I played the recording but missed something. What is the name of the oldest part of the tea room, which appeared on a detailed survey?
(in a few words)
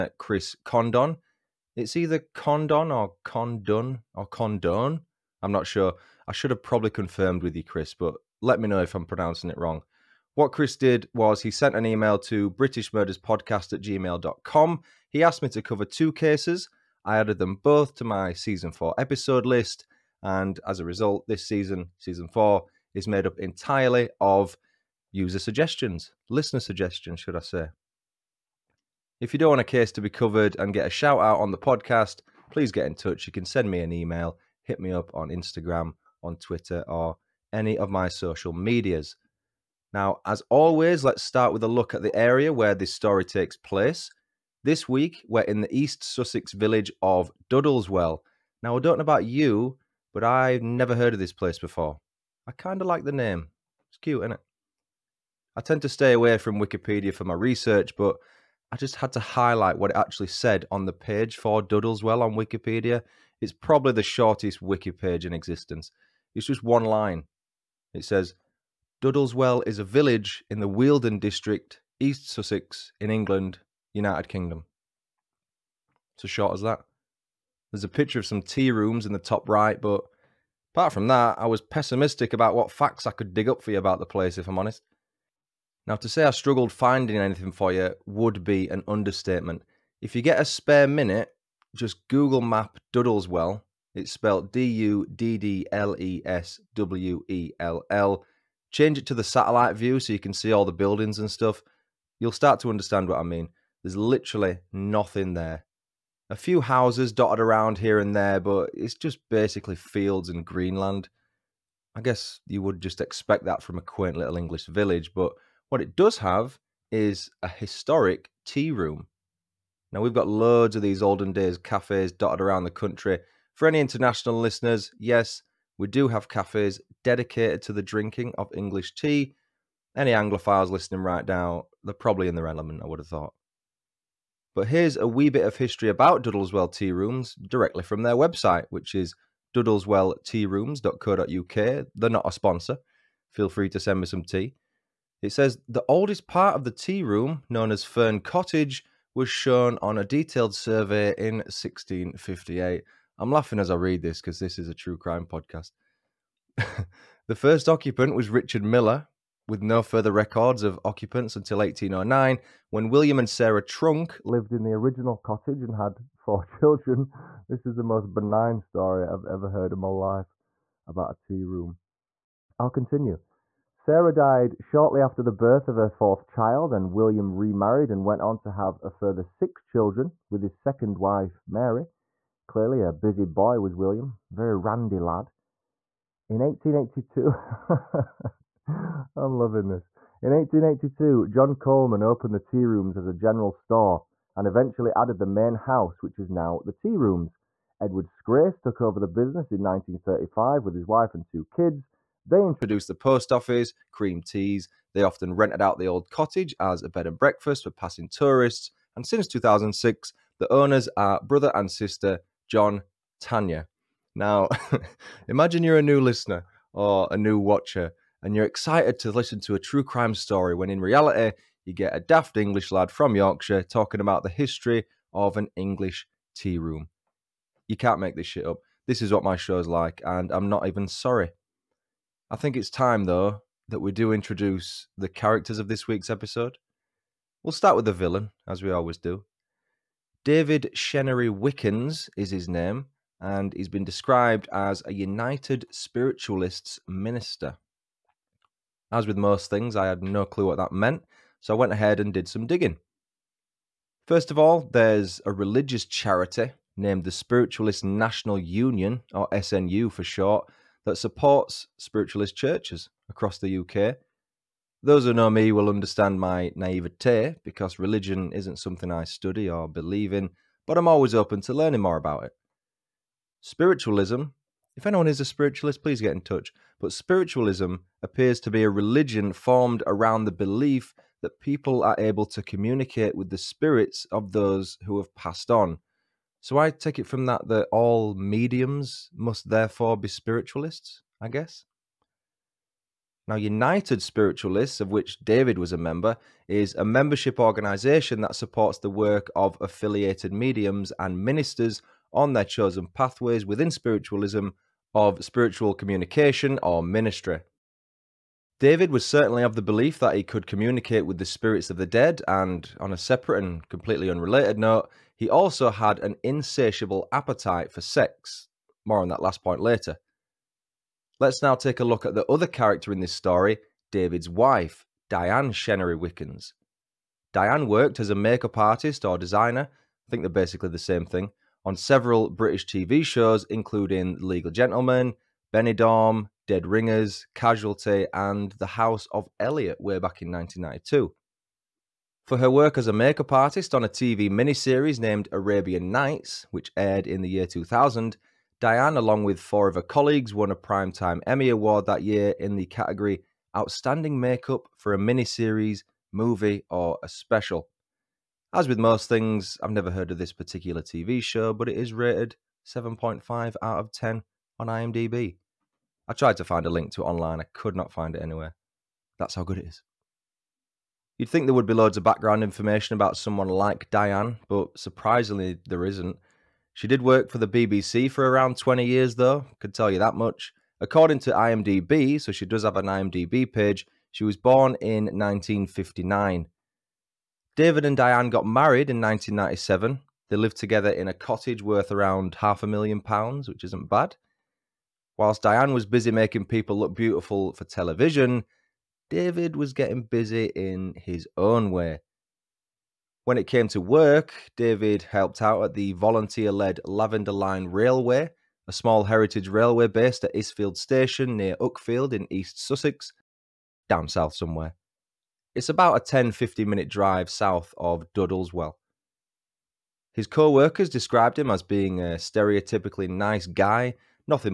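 Fern Cottage.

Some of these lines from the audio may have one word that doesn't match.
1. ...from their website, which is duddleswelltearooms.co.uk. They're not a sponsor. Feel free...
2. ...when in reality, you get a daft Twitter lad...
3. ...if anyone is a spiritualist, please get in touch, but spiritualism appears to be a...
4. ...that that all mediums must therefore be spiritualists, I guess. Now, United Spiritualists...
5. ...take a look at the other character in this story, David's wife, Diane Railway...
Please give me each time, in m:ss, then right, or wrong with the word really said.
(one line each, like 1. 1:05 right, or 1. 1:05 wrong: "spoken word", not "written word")
1. 2:17 right
2. 3:40 wrong: "English", not "Twitter"
3. 4:34 right
4. 4:47 right
5. 5:21 wrong: "Chenery", not "Railway".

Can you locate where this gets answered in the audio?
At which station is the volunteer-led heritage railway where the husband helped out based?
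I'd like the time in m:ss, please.
6:50.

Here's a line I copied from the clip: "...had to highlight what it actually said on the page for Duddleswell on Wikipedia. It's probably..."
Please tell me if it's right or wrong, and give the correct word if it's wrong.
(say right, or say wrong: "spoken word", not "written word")
right.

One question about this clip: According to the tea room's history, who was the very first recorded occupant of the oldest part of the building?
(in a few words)
Richard Miller.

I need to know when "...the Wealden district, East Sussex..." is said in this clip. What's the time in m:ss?
1:10.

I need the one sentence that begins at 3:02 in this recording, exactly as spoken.
Clearly, a busy boy was William, very randy lad.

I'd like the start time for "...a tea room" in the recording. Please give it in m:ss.
2:51.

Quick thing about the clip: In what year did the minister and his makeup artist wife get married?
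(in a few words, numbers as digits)
1997.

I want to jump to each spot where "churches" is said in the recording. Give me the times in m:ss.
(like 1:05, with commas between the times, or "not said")
4:22.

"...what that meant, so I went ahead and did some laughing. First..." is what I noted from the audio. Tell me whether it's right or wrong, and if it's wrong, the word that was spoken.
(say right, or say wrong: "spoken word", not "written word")
wrong: "digging", not "laughing".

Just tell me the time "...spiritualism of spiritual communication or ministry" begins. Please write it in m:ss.
5:03.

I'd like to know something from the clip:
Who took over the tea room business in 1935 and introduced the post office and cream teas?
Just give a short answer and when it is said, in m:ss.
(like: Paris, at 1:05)
Edward Scrace, at 3:17.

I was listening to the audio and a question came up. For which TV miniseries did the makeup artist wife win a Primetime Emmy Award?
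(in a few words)
Arabian Nights.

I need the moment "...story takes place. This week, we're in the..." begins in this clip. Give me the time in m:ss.
0:42.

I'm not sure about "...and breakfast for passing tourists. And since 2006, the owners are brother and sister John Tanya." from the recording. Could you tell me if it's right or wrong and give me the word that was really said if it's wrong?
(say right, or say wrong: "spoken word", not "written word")
right.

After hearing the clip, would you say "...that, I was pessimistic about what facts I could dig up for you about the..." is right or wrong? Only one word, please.
right.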